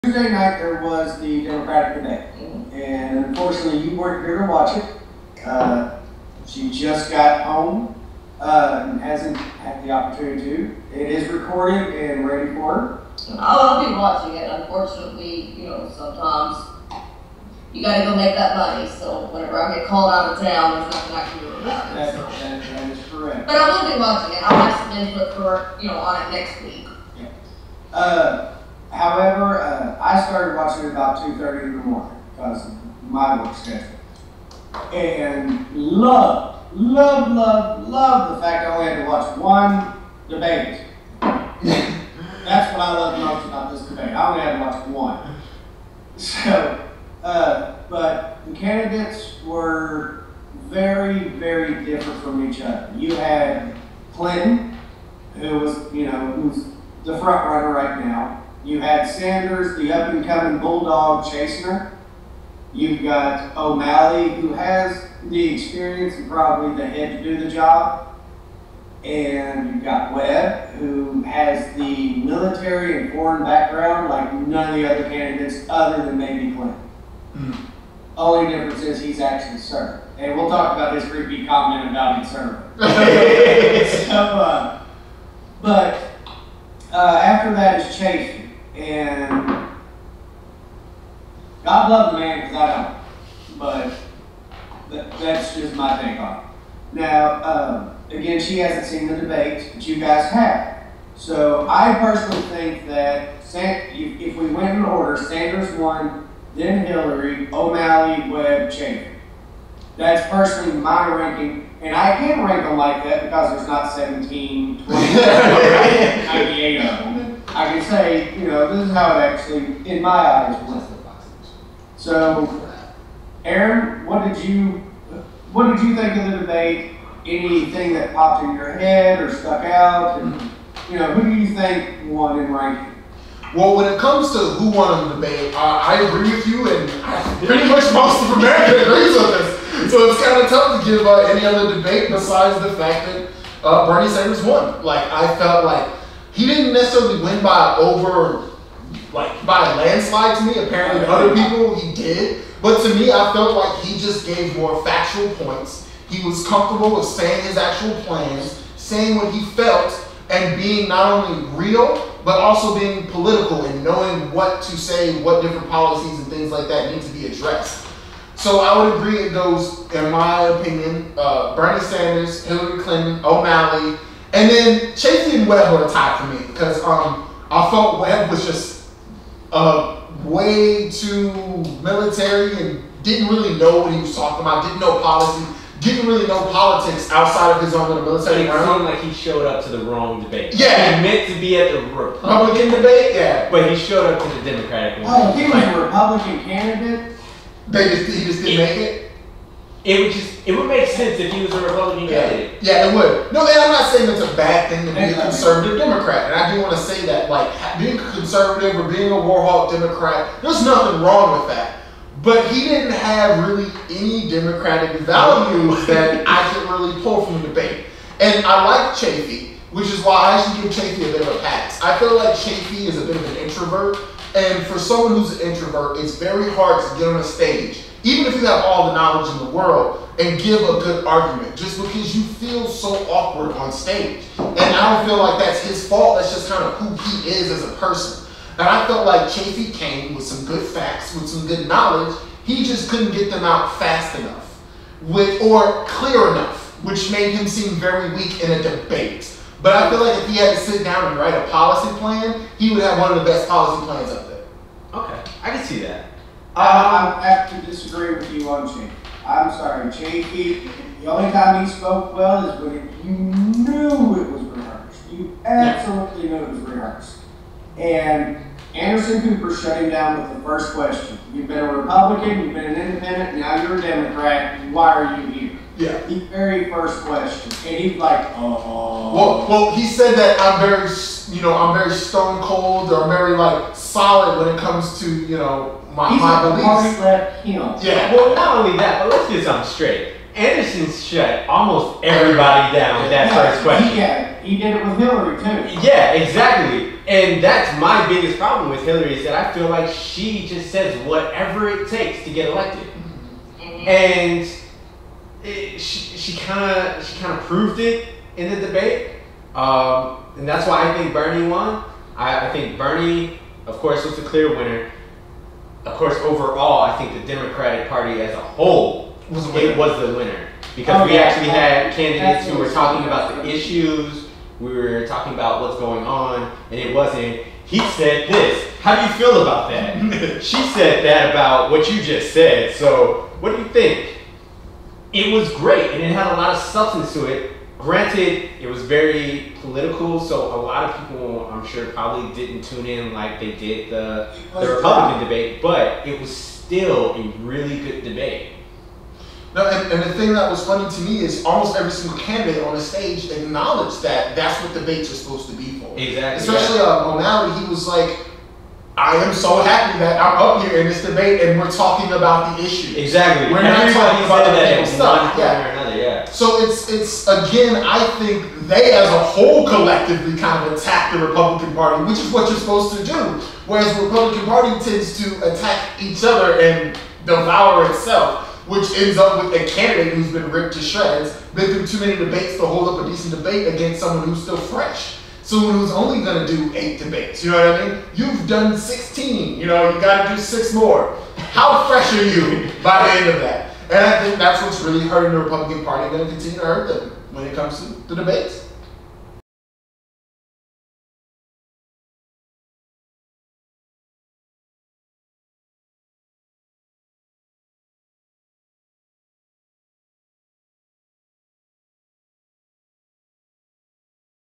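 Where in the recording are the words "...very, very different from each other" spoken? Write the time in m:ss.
0:50.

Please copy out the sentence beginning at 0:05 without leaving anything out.
Uh, she just got home uh, and hasn't had the opportunity to.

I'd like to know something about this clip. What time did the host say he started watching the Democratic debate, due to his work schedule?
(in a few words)
2:30 in the morning.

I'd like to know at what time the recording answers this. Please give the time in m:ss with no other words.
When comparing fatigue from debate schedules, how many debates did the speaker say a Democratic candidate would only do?
6:26.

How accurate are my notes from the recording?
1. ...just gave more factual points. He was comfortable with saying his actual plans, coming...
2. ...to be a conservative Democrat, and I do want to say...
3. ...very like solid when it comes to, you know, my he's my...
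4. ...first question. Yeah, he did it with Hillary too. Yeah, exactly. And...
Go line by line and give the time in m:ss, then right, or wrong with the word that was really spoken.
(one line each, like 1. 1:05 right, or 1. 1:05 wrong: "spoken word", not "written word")
1. 2:33 wrong: "saying", not "coming"
2. 3:24 right
3. 4:43 right
4. 4:53 right.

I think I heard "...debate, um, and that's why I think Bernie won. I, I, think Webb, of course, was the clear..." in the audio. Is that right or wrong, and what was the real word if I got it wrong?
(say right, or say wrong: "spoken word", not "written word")
wrong: "Bernie", not "Webb".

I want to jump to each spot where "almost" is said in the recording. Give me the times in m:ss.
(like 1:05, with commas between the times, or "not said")
4:51, 5:51.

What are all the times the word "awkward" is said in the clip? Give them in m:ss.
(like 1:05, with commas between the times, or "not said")
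3:53.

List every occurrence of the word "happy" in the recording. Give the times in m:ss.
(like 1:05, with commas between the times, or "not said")
5:59.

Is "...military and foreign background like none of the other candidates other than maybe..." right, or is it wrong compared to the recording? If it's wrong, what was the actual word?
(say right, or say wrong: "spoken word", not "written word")
right.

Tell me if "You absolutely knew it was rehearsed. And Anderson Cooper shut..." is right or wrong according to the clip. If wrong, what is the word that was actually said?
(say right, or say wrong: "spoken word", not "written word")
right.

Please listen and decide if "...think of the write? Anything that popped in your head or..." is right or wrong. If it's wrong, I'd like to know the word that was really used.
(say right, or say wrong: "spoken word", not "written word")
wrong: "debate", not "write".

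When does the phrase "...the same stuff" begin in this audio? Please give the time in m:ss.
6:04.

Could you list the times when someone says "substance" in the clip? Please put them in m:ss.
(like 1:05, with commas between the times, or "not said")
5:36.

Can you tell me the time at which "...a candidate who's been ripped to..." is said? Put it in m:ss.
6:19.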